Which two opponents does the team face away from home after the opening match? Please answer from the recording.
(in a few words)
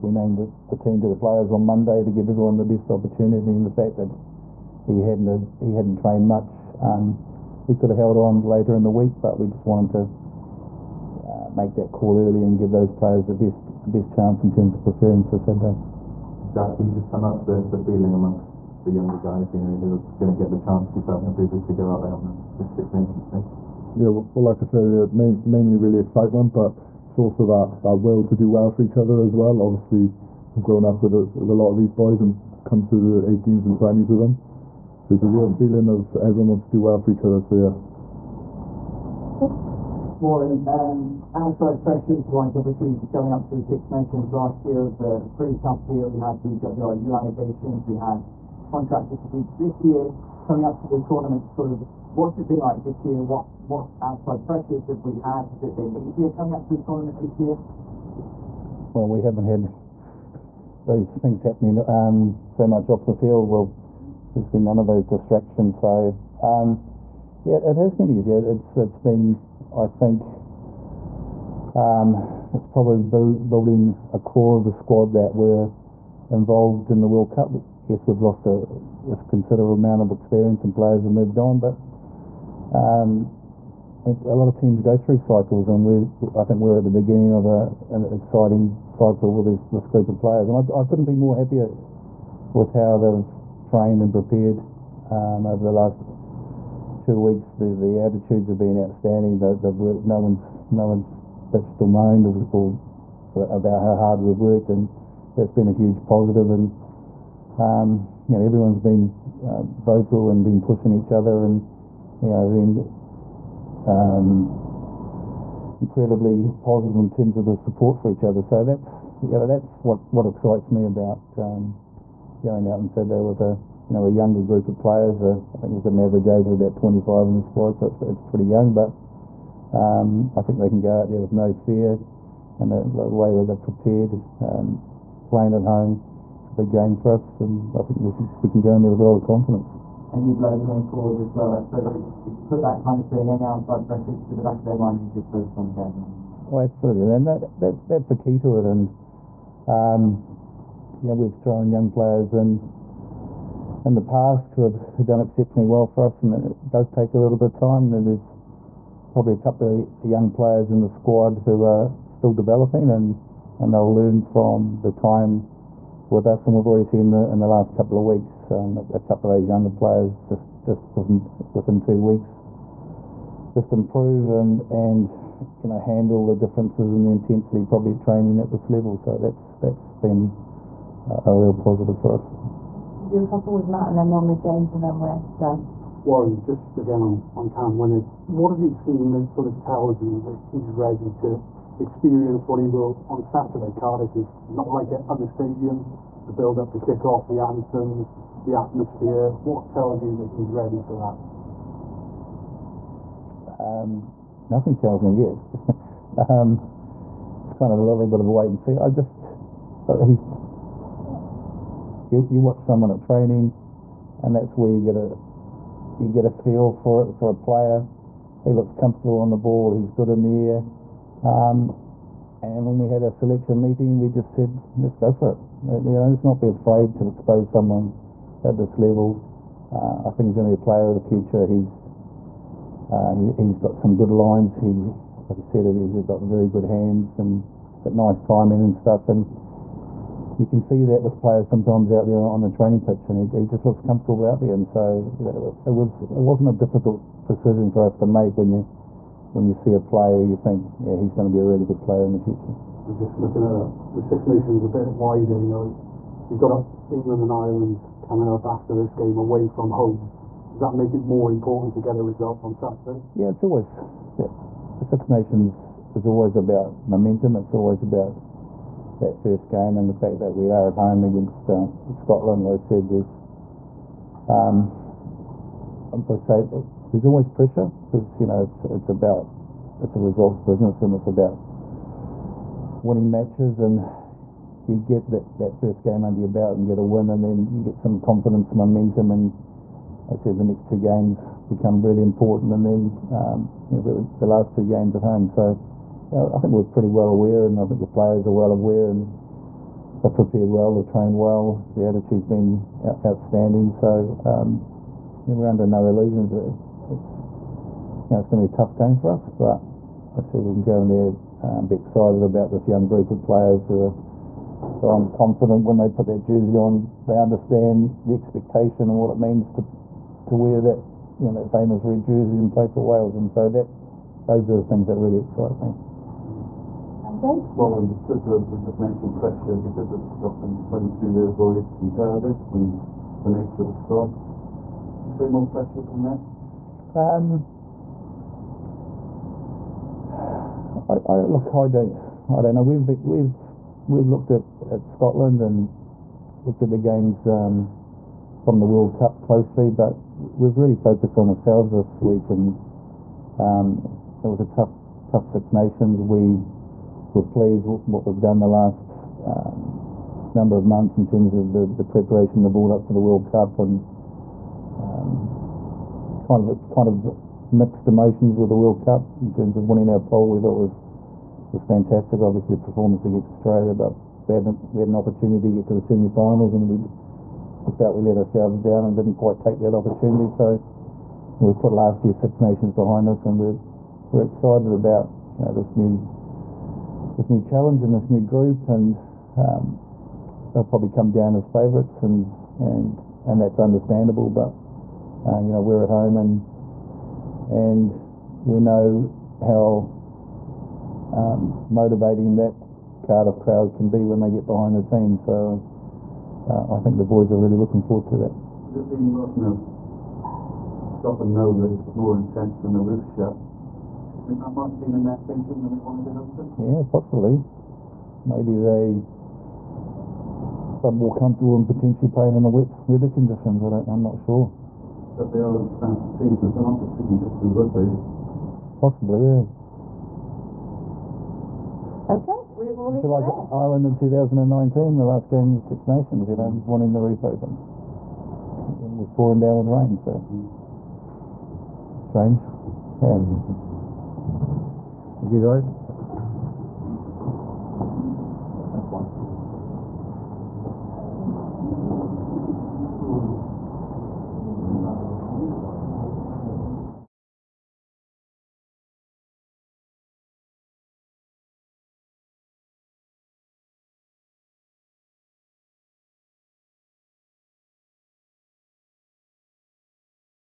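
England and Ireland.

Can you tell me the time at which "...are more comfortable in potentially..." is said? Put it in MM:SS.
07:00.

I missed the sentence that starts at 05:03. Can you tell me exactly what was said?
So um, you know, we're under no illusions.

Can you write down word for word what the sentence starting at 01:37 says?
The, the attitudes have been outstanding.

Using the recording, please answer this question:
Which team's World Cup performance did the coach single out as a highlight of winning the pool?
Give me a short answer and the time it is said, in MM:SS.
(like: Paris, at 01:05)
Australia, at 06:13.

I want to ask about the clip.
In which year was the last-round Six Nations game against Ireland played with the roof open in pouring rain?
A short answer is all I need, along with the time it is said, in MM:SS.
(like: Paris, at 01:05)
2019, at 07:13.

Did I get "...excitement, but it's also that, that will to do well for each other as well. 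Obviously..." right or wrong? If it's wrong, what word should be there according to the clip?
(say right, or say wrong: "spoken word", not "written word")
right.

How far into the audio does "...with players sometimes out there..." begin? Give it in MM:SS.
04:01.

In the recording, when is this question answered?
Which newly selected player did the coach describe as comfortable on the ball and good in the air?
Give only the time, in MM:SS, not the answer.
03:07.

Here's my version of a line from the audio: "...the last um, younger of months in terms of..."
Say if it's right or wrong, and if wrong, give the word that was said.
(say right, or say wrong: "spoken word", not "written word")
wrong: "number", not "younger".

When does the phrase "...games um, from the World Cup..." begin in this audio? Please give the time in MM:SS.
05:46.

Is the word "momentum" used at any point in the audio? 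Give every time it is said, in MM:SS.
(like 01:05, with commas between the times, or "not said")
04:26, 04:48.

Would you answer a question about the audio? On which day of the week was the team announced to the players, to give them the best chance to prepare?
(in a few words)
Monday.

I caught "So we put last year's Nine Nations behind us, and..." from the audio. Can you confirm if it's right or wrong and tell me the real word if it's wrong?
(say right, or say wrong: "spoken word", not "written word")
wrong: "Six", not "Nine".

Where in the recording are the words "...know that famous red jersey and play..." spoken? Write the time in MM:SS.
05:21.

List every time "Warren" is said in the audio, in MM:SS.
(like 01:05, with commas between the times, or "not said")
00:40, 03:06.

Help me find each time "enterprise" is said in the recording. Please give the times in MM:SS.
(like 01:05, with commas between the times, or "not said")
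not said.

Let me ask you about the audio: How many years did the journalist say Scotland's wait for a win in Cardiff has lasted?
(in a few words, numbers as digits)
22 years.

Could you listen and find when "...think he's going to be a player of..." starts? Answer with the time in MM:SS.
03:50.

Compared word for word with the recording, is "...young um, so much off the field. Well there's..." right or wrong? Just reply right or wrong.
wrong.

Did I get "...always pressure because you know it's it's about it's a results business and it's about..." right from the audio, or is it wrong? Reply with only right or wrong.
right.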